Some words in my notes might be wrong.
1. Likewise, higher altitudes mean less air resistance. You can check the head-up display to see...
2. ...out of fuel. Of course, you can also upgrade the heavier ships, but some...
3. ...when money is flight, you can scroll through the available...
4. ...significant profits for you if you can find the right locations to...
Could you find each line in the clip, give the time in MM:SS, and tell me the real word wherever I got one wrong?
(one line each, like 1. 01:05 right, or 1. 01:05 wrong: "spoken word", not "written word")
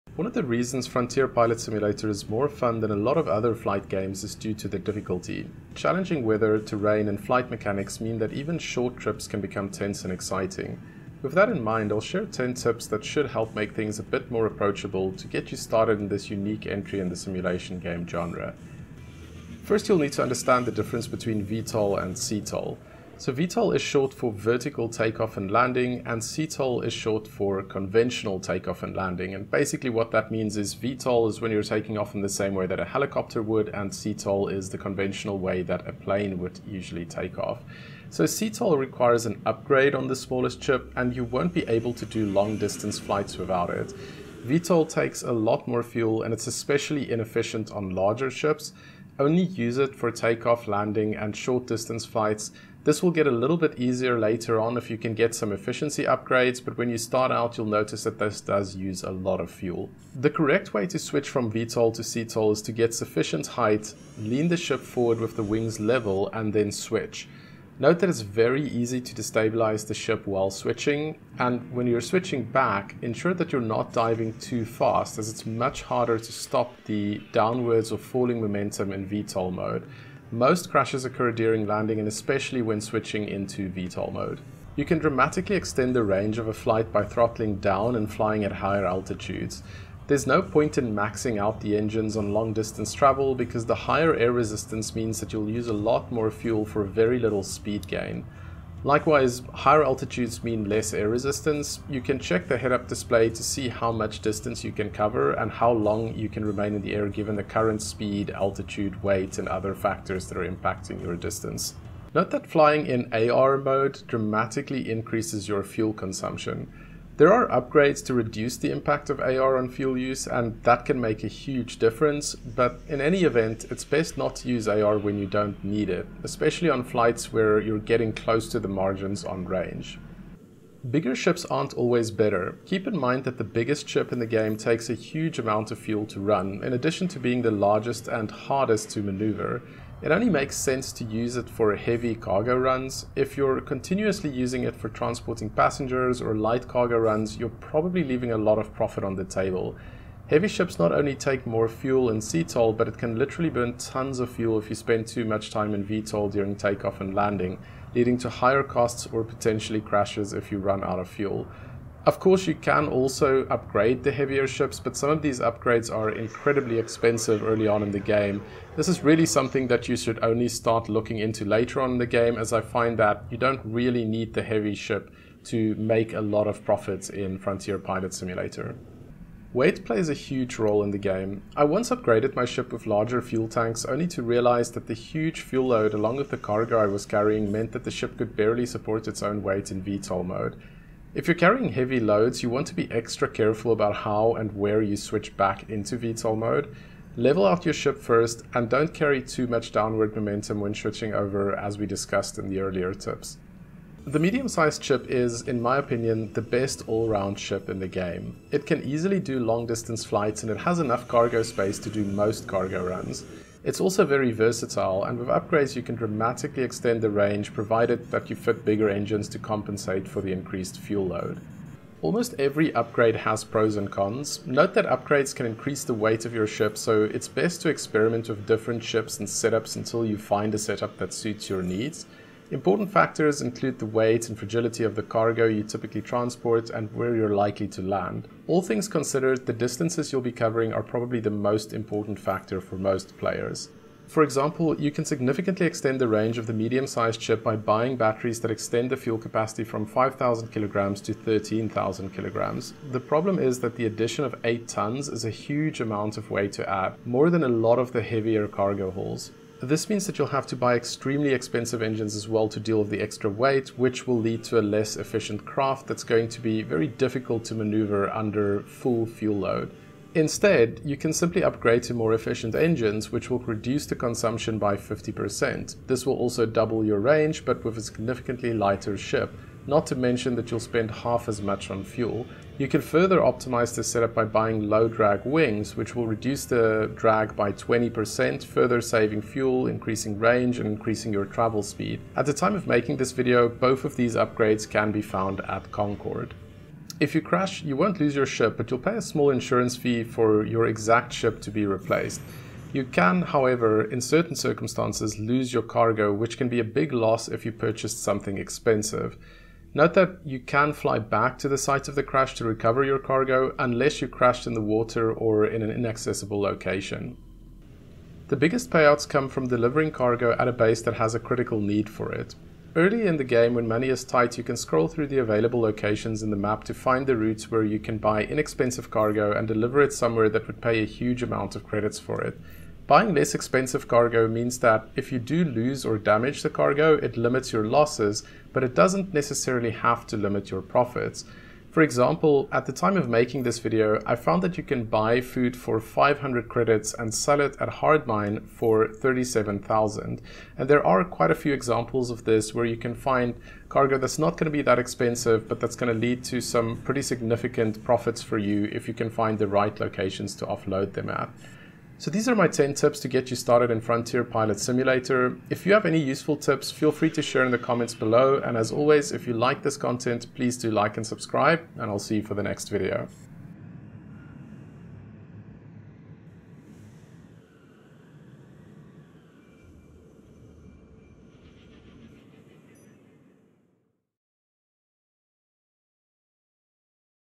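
1. 01:38 right
2. 02:40 right
3. 05:23 wrong: "tight", not "flight"
4. 05:57 right.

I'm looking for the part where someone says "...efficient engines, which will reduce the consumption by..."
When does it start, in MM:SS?
04:32.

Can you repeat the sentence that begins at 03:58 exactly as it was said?
All things considered, the distances you'll be covering are probably the most important factor for most players.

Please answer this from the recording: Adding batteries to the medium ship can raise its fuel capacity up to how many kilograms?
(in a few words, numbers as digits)
13,000 kilograms.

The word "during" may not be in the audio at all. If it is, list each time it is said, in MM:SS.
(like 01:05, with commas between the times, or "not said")
01:21, 02:36.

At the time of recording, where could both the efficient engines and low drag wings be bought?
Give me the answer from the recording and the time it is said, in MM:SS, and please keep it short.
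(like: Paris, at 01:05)
Concord, at 04:55.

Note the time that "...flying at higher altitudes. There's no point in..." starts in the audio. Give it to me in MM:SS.
01:28.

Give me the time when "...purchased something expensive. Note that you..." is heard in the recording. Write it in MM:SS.
05:07.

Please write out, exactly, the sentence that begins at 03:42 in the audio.
Almost every upgrade has pros and cons.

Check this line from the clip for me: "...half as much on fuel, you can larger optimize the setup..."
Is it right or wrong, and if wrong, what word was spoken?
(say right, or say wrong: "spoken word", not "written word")
wrong: "further", not "larger".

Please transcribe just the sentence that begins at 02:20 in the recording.
It only makes sense to use it for heavy cargo runs.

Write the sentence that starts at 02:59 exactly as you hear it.
Weight plays a huge role in the game.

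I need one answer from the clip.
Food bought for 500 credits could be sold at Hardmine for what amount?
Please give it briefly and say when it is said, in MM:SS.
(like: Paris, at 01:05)
37,000 credits, at 05:48.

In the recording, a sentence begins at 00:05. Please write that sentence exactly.
Challenging weather, terrain, and flight mechanics mean that even short trips can become tense and exciting.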